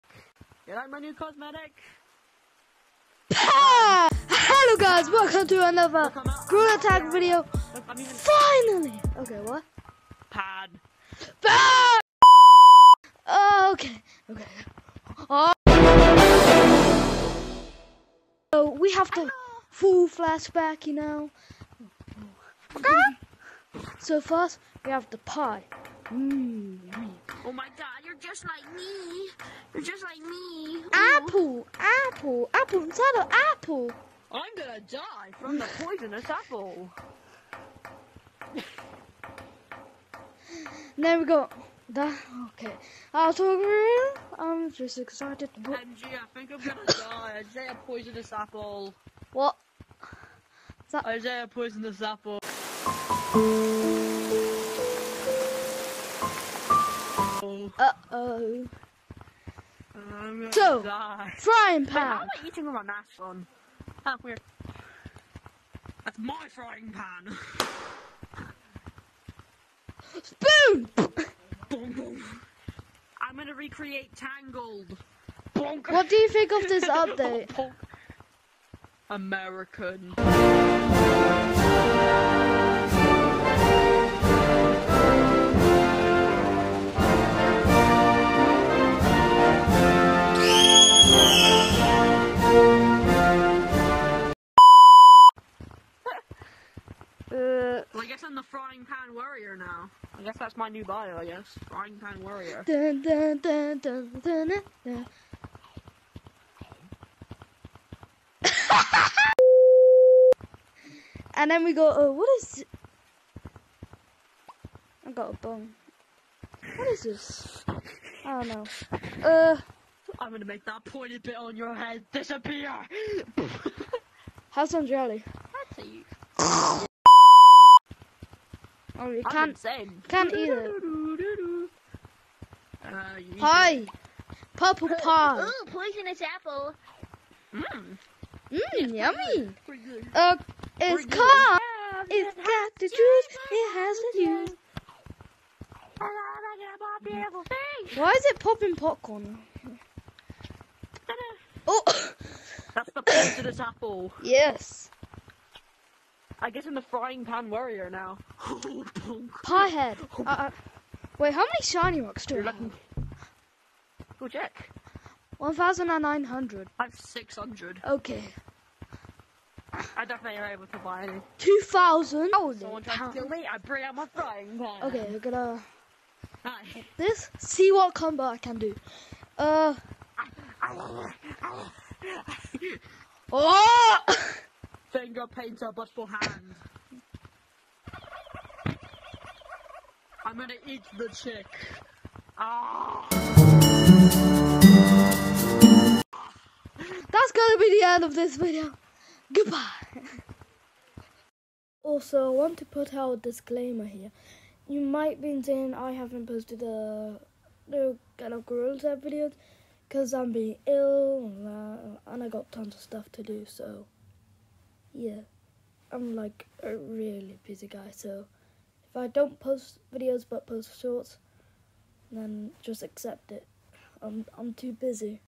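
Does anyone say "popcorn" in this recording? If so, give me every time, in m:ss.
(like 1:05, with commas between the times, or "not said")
2:28.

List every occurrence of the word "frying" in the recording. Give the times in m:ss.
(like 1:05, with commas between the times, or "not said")
1:01, 1:06, 1:41, 2:36, 2:54.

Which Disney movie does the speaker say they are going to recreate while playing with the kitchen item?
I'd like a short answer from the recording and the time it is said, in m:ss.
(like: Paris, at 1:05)
Tangled, at 1:14.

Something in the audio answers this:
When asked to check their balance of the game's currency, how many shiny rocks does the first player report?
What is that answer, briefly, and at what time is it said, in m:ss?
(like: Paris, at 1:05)
1,900, at 2:45.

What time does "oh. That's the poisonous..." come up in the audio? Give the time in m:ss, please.
2:31.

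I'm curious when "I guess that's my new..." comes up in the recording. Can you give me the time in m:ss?
1:40.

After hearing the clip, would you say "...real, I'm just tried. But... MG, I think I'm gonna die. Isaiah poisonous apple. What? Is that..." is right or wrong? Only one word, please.
wrong.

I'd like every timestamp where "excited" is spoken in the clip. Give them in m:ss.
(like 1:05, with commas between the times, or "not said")
0:44.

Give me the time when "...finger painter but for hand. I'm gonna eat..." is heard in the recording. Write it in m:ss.
3:05.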